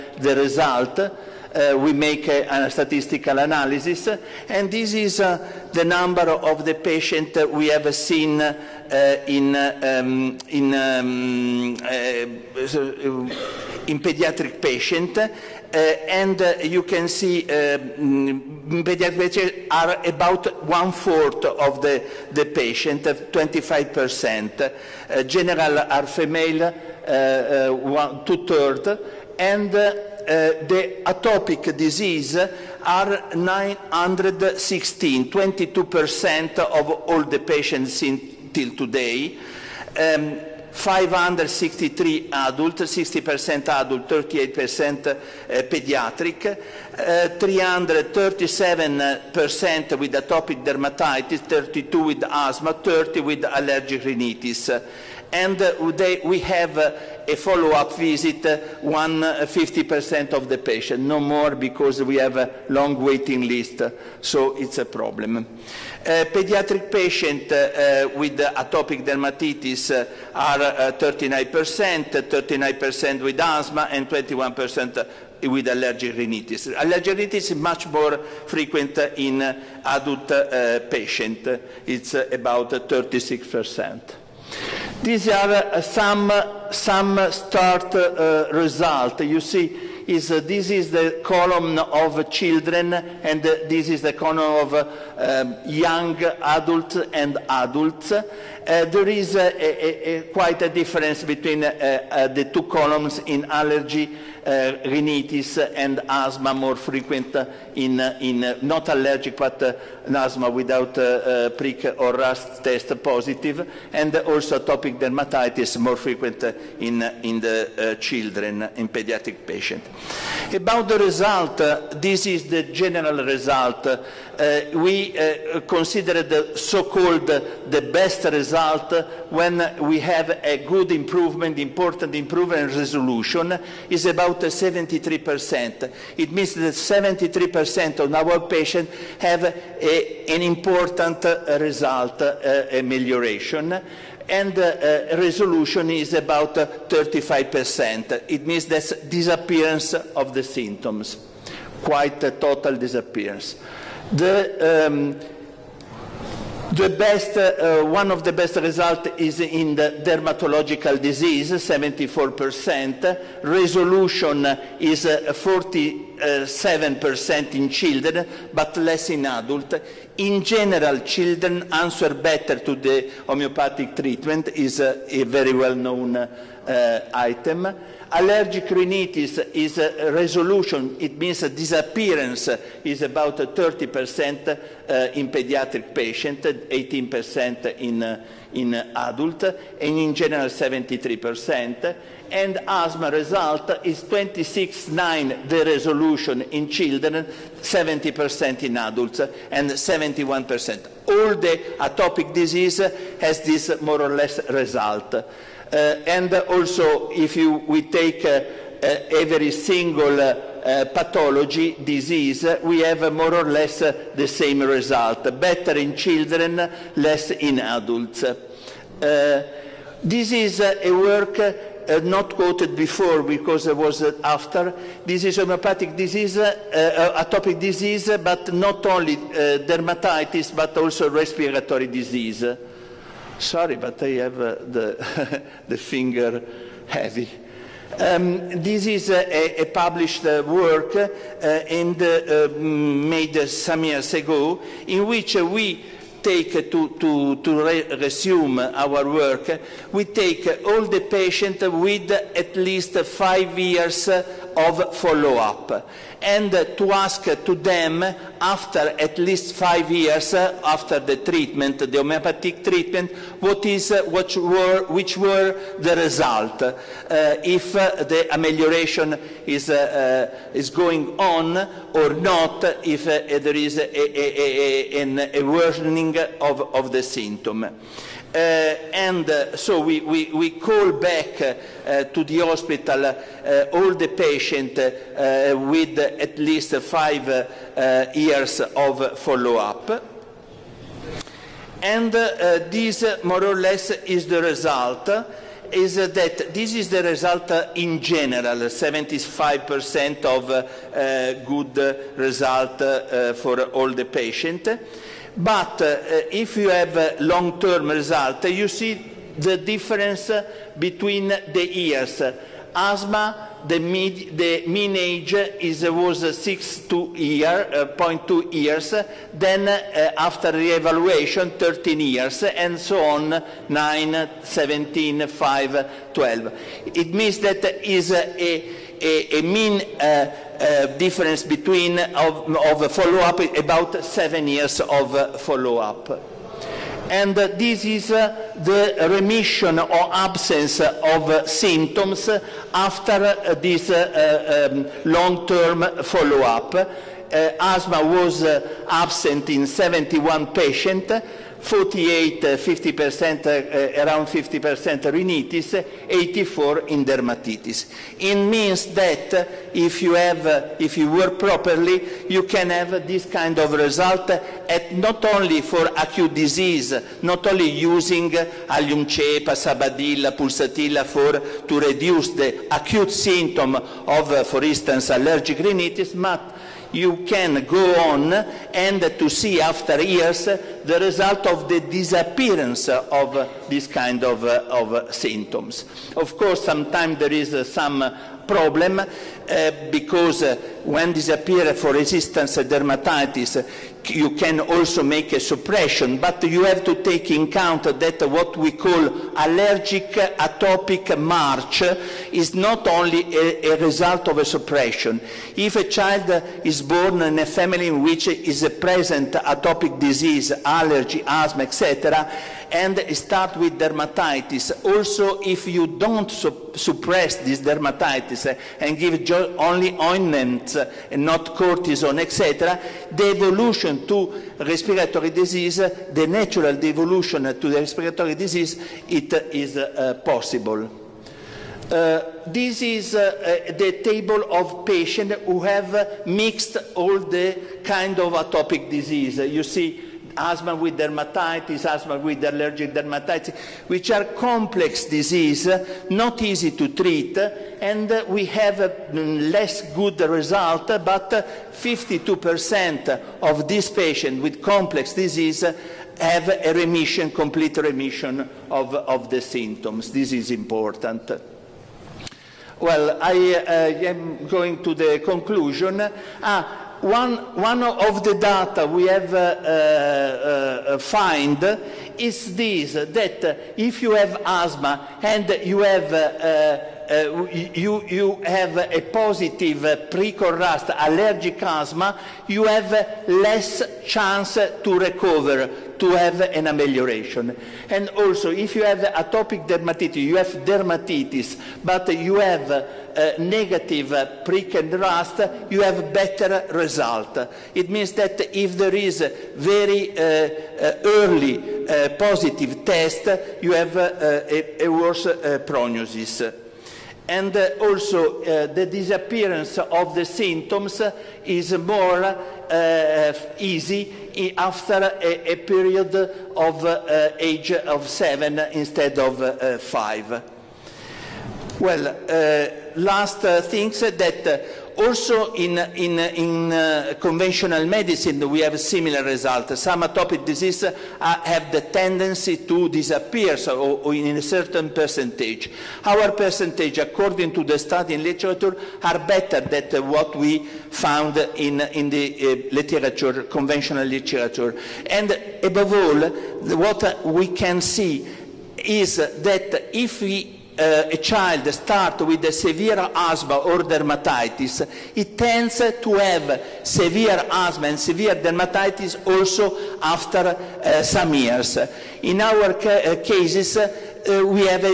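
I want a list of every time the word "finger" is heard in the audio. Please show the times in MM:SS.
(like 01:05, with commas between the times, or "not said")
03:55.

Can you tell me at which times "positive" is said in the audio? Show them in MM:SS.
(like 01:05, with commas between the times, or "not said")
01:53, 07:59, 08:22.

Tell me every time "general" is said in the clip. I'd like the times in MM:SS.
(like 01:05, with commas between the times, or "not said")
00:25, 02:02, 02:50, 03:10, 04:58.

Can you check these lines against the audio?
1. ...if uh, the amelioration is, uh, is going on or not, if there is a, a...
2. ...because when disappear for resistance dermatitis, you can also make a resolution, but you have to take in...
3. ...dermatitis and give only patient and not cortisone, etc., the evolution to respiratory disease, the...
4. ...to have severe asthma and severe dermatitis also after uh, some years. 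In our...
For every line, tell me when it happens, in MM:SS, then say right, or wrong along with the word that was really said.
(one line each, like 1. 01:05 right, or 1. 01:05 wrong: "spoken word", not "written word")
1. 04:27 right
2. 06:29 wrong: "suppression", not "resolution"
3. 06:57 wrong: "ointment", not "patient"
4. 09:16 right.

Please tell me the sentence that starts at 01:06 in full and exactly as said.
pediatric patients with atopic dermatitis are 39%, 39% with asthma, and 21% with allergic rhinitis.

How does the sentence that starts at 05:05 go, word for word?
But uh, if you have uh, long-term result, you see the difference uh, between the years.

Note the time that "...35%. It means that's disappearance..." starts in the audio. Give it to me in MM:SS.
02:26.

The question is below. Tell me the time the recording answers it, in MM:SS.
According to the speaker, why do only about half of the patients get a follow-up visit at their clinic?
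01:02.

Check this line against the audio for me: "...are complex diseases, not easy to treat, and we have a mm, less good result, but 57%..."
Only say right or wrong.
wrong.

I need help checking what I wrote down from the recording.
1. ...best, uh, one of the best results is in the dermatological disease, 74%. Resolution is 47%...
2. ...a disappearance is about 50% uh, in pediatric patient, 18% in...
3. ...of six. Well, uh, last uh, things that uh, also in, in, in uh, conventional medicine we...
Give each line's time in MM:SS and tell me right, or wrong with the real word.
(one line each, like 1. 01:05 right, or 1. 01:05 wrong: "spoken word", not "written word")
1. 02:36 right
2. 03:01 wrong: "30", not "50"
3. 08:39 wrong: "five", not "six".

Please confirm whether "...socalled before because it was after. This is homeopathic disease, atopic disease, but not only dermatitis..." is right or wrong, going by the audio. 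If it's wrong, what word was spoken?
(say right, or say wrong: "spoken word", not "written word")
wrong: "quoted", not "socalled".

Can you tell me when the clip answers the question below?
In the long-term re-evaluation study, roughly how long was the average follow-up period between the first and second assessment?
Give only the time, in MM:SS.
05:34.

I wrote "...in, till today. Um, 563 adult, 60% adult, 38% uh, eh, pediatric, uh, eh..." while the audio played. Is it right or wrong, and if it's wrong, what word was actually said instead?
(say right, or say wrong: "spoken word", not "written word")
right.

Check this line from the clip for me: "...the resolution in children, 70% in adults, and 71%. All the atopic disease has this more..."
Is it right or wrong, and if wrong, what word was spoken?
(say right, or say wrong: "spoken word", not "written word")
right.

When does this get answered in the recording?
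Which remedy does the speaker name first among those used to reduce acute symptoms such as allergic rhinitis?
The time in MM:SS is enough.
06:08.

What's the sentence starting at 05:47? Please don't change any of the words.
asthma was absent in 71 patients 48, 50%, eh, eh, around 50% rhinitis, 84 in dermatitis.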